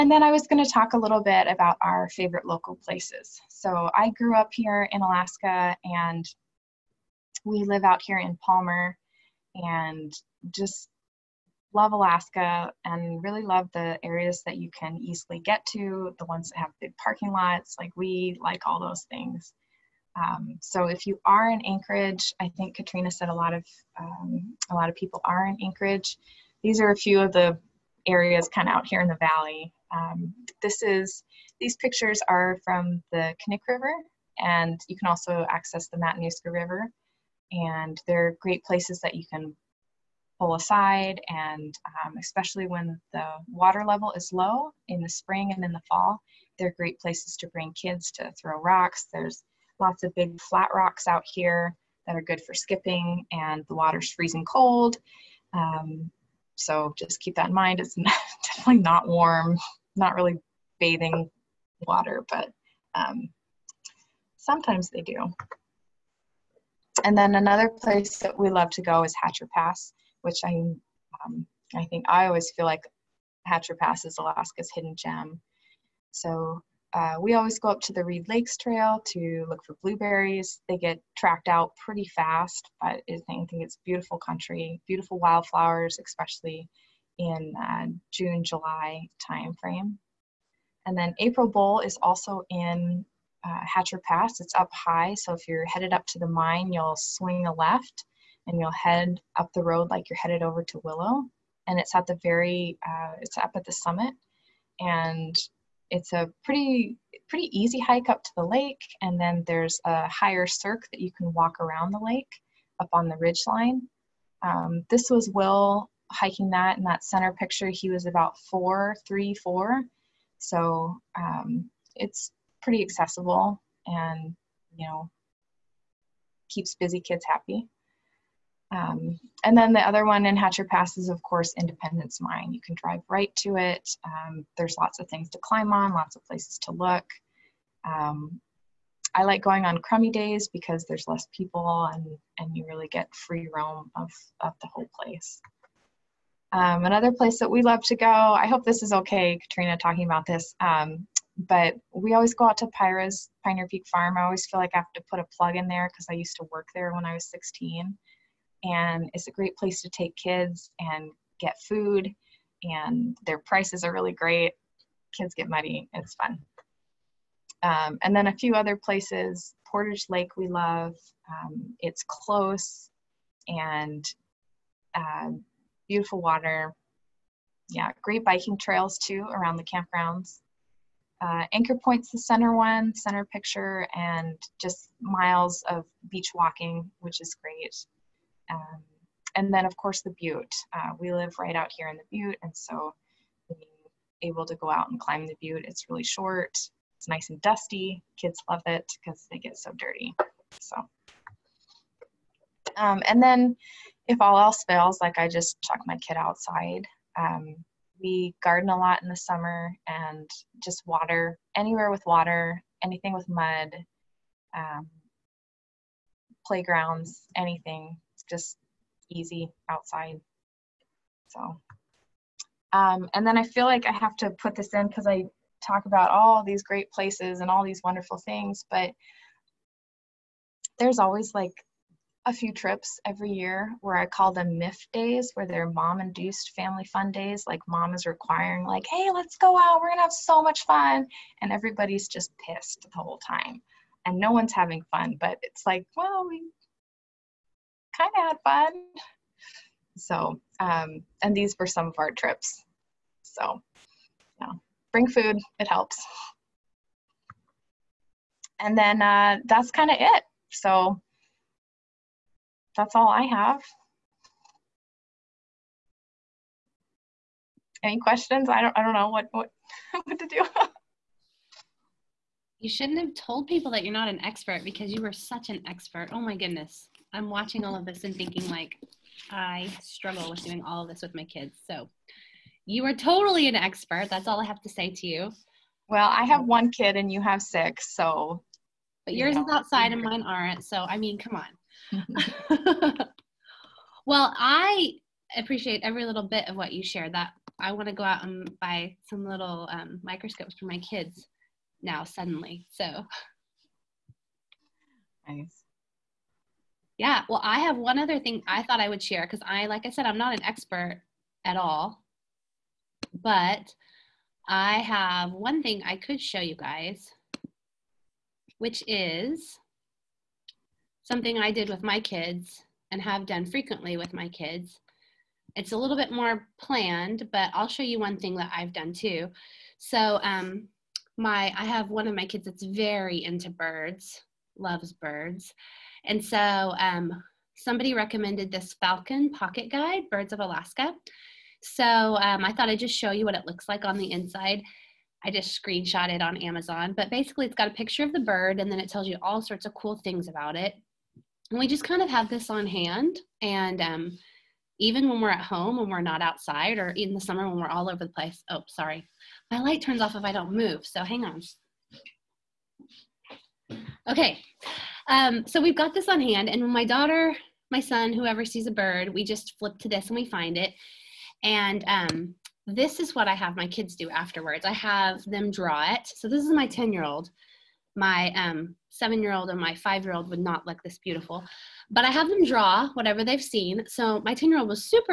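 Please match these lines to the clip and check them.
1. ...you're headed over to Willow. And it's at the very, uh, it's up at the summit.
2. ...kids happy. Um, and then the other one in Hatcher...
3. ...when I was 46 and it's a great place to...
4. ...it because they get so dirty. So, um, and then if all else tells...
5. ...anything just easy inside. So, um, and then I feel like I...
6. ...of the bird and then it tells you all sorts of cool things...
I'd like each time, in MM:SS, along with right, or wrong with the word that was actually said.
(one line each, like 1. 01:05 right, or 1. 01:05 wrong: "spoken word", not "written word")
1. 01:40 right
2. 02:07 right
3. 02:36 wrong: "16", not "46"
4. 03:18 wrong: "fails", not "tells"
5. 03:37 wrong: "outside", not "inside"
6. 05:48 right.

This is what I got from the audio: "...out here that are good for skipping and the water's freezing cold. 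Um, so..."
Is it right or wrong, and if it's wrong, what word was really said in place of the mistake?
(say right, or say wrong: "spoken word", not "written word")
right.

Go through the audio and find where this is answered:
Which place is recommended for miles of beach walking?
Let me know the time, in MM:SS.
03:01.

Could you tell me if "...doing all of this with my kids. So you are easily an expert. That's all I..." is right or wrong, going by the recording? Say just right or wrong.
wrong.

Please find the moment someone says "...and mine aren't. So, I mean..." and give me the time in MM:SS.
04:49.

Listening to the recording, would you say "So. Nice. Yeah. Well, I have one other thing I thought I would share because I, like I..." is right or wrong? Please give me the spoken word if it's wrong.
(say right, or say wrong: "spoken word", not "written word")
right.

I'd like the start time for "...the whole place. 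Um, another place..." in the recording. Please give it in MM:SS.
02:24.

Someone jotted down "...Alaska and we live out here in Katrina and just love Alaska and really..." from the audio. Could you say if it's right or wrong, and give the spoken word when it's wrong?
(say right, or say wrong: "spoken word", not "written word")
wrong: "Palmer", not "Katrina".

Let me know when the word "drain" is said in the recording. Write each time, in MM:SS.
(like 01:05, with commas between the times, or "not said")
not said.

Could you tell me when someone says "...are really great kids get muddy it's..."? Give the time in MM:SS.
02:43.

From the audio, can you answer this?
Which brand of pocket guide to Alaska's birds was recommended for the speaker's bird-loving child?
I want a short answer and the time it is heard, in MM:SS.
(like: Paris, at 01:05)
Falcon, at 05:38.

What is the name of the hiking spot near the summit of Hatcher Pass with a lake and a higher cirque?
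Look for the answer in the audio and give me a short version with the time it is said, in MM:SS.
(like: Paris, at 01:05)
April Bowl, at 01:31.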